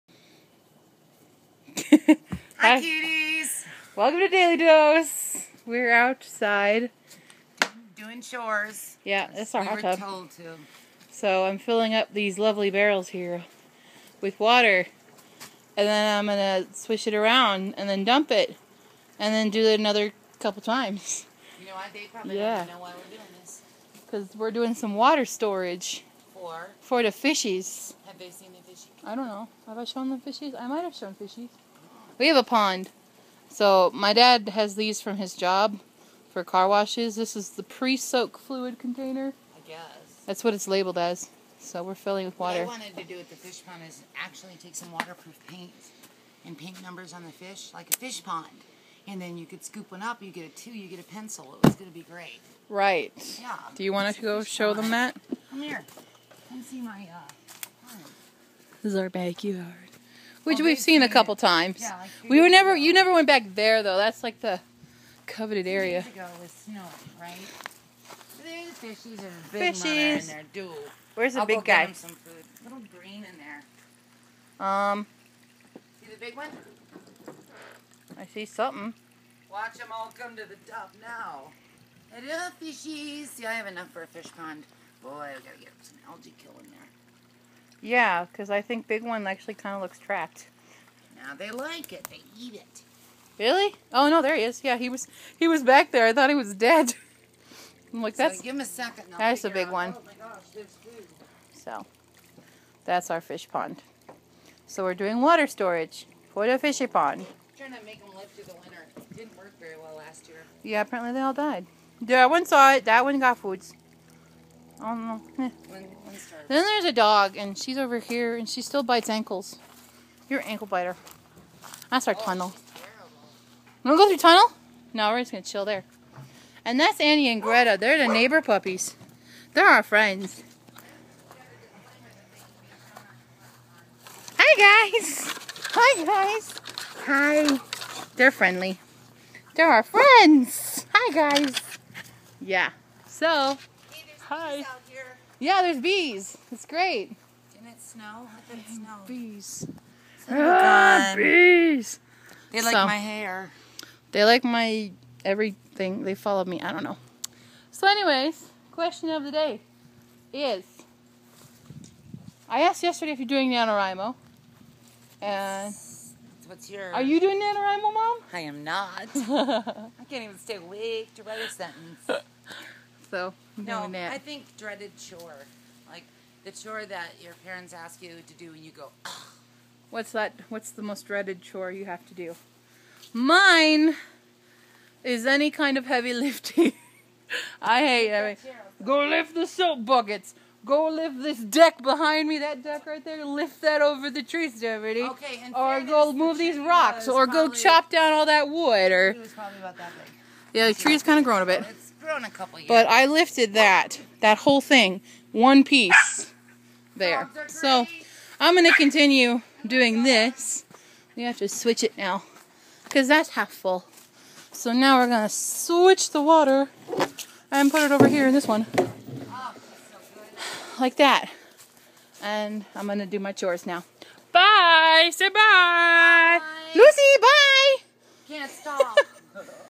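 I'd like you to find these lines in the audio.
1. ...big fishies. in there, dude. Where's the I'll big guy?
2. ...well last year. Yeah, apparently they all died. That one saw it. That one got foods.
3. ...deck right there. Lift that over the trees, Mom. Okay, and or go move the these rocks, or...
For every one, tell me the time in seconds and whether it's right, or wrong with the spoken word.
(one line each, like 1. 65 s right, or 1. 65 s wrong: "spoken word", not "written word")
1. 69 s right
2. 109 s right
3. 192 s wrong: "Deputy", not "Mom".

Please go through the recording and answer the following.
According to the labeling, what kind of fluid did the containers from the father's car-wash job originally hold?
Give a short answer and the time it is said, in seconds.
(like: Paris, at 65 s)
pre-soak fluid, at 37 s.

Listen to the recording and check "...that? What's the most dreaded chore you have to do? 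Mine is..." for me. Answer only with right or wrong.
right.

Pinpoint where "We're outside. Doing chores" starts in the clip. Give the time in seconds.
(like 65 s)
5 s.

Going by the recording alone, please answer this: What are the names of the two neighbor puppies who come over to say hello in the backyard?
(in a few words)
Annie and Greta.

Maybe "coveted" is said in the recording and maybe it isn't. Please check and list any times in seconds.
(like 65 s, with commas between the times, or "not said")
65 s.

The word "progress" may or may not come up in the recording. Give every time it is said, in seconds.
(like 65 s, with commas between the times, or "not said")
not said.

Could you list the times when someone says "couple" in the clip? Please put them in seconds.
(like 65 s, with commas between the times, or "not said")
20 s, 61 s, 202 s.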